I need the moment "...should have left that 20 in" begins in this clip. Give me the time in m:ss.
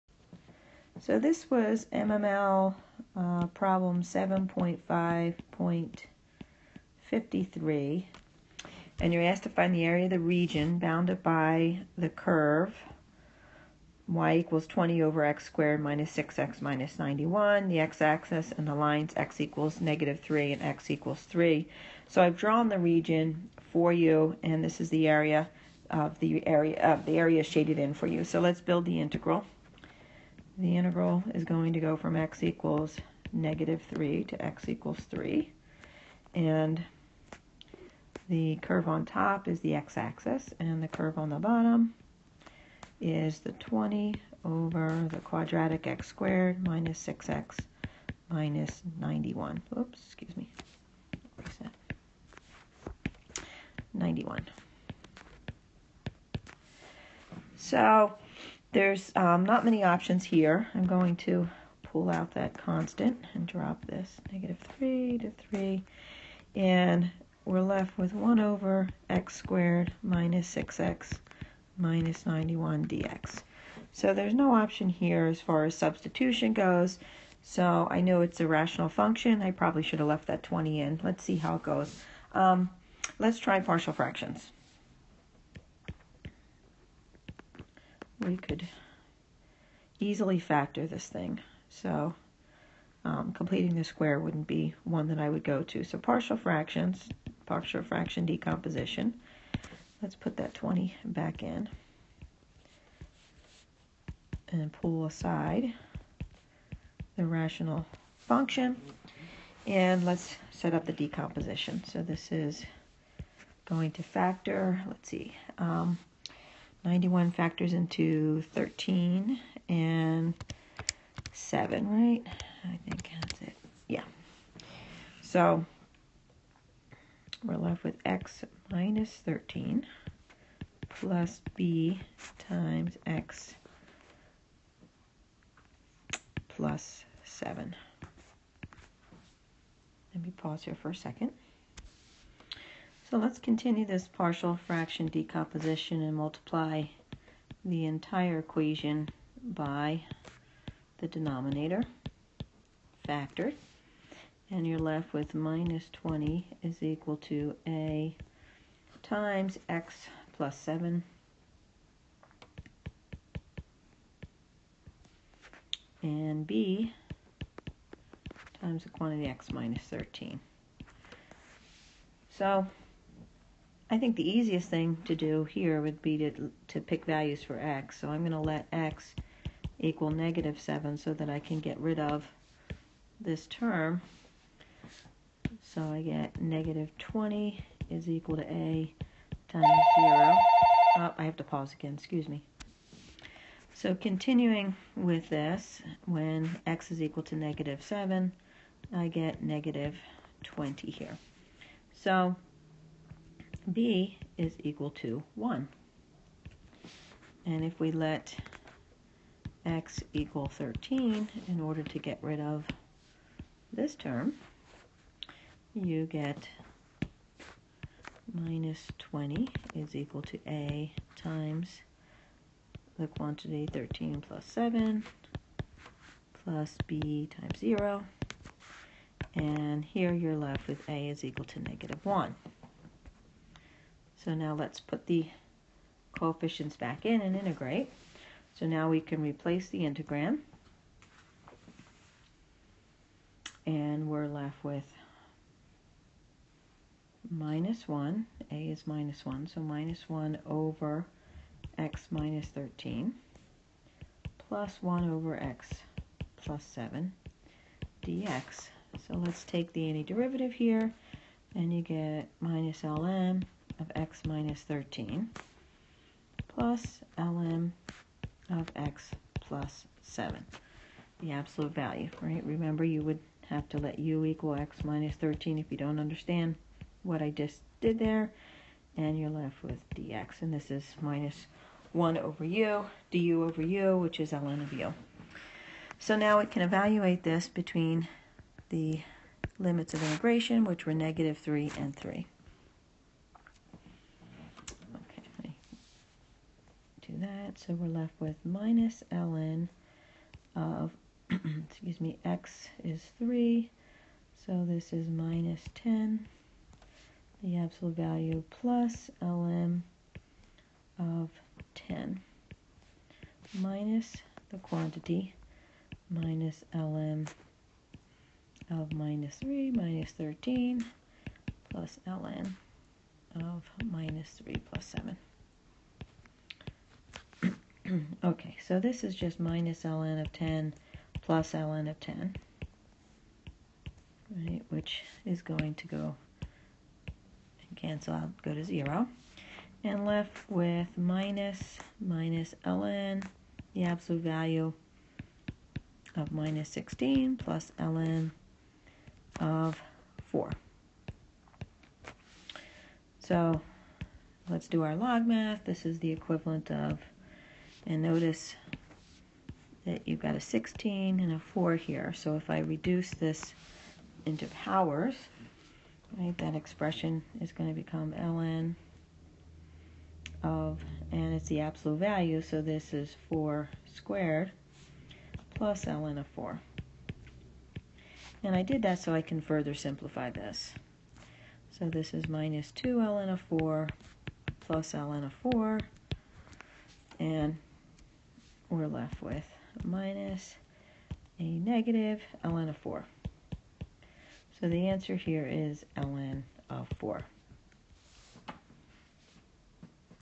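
1:19.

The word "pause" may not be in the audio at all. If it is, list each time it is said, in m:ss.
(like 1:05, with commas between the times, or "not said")
2:20, 3:11.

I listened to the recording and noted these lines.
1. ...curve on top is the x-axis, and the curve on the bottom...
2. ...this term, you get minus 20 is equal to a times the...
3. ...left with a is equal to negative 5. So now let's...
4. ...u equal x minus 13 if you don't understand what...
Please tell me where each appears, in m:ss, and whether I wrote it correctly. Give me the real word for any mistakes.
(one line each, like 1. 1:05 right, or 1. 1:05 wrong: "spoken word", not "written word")
1. 0:38 right
2. 3:33 right
3. 3:50 wrong: "1", not "5"
4. 4:33 right.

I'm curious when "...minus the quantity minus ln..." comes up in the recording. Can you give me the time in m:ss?
5:13.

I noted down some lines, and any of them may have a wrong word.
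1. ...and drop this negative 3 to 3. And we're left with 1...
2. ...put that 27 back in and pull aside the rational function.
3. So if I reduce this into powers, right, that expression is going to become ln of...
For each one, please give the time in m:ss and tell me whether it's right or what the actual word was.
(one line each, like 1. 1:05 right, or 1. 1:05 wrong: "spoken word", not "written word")
1. 1:03 right
2. 1:40 wrong: "20", not "27"
3. 6:02 right.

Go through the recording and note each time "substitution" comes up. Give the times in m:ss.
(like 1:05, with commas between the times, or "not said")
1:15.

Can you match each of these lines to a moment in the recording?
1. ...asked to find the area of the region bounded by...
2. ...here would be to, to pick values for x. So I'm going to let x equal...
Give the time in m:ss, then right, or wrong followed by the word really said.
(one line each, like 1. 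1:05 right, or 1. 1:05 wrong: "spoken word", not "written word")
1. 0:09 right
2. 2:55 right.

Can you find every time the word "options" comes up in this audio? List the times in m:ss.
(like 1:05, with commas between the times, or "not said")
0:59, 1:14.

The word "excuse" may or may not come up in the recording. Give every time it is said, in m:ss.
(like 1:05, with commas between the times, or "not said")
0:50, 3:11, 5:01.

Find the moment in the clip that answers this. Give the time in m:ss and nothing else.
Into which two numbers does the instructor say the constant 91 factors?
1:58.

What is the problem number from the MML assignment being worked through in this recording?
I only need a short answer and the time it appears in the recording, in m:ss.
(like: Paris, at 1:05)
7.5.53, at 0:04.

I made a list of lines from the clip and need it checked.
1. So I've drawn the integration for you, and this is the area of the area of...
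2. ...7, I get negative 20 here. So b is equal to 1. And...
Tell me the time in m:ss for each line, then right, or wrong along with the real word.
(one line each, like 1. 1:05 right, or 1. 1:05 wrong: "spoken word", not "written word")
1. 0:22 wrong: "region", not "integration"
2. 3:17 right.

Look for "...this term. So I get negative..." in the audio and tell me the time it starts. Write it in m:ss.
3:03.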